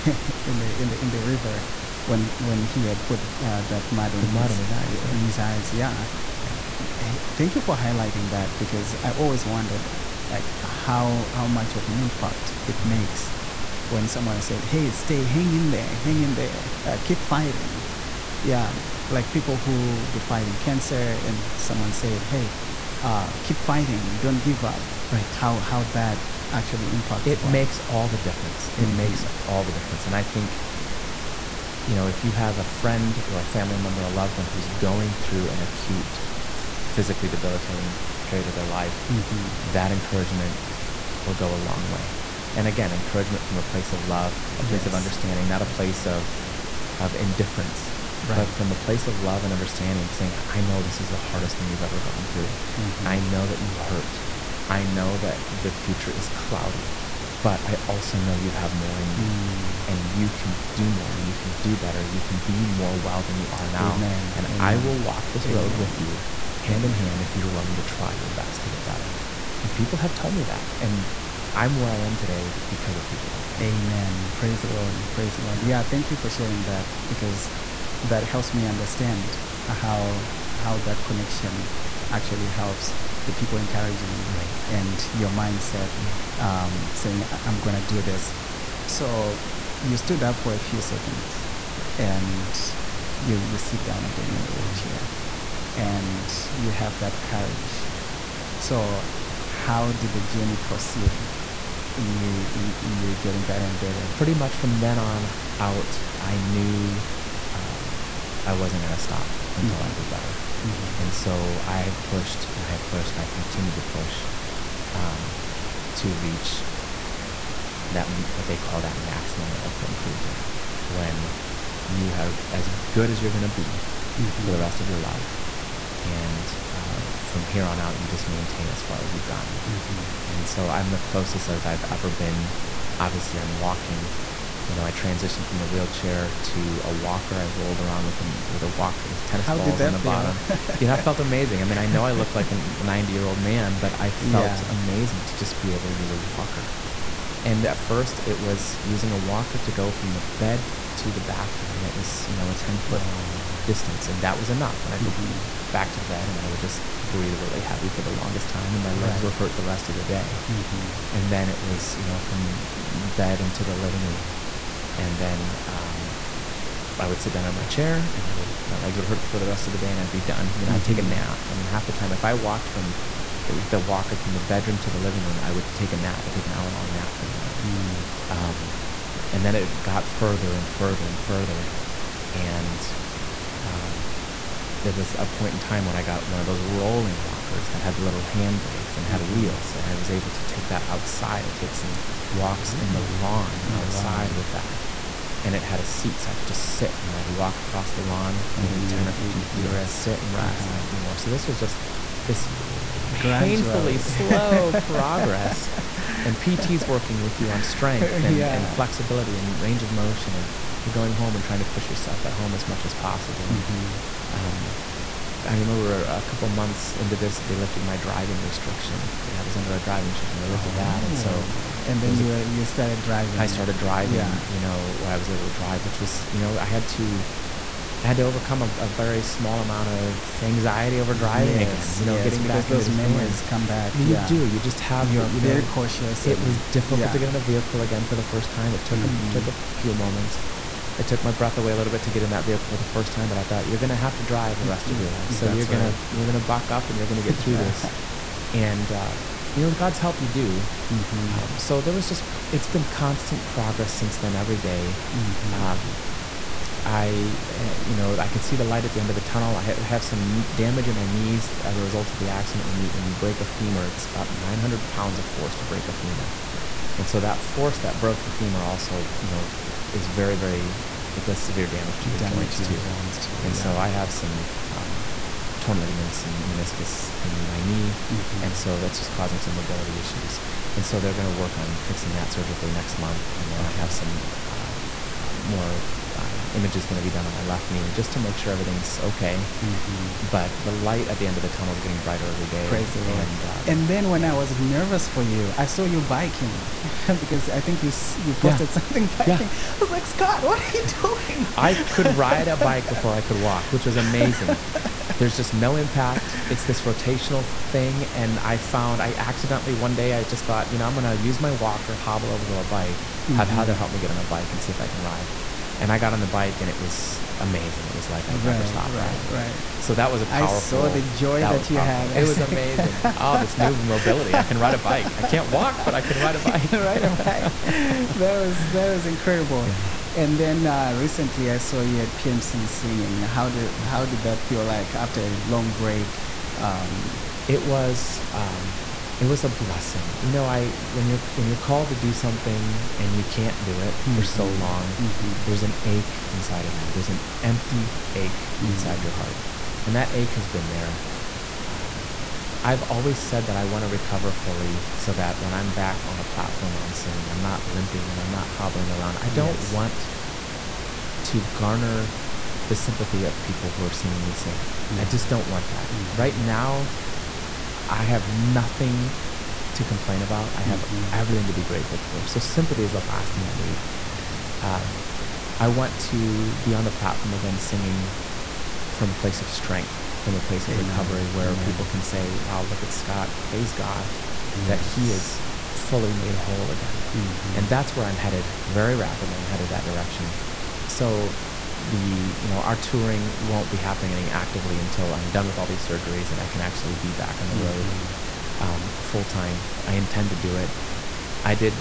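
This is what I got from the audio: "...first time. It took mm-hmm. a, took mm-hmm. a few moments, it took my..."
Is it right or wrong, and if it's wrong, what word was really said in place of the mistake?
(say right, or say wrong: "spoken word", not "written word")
right.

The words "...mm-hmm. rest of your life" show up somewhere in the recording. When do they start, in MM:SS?
02:04.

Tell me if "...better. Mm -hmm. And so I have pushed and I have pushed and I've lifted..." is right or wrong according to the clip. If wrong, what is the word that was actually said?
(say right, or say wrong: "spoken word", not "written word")
wrong: "continued", not "lifted".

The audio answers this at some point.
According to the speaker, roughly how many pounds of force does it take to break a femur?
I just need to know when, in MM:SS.
04:24.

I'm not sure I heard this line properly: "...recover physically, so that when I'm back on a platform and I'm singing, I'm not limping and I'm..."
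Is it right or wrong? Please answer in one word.
wrong.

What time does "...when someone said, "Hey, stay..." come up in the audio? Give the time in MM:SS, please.
00:13.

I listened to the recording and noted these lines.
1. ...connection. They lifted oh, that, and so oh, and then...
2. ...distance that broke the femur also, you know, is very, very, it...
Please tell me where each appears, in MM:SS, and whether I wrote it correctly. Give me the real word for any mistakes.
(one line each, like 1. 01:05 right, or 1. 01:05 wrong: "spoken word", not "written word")
1. 03:40 wrong: "restriction", not "connection"
2. 04:27 wrong: "force", not "distance".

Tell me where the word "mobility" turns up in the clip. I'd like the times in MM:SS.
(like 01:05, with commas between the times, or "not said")
04:39, 05:23.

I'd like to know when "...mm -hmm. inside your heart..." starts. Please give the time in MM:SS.
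05:48.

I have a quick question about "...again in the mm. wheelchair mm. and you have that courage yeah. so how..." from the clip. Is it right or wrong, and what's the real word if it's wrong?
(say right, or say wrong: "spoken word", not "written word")
right.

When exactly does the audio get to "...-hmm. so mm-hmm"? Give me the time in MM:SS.
05:44.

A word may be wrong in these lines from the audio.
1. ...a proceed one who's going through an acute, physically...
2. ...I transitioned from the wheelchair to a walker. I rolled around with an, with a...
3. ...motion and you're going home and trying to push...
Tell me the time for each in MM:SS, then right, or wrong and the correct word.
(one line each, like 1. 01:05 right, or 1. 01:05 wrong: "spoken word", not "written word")
1. 00:34 wrong: "loved", not "proceed"
2. 02:14 right
3. 03:29 right.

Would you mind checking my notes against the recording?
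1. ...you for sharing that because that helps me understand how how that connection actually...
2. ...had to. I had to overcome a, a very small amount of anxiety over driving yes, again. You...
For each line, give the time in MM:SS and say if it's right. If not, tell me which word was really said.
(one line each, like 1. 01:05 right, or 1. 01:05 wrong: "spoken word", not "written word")
1. 01:16 right
2. 03:46 right.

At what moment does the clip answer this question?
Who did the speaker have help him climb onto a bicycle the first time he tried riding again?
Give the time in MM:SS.
05:13.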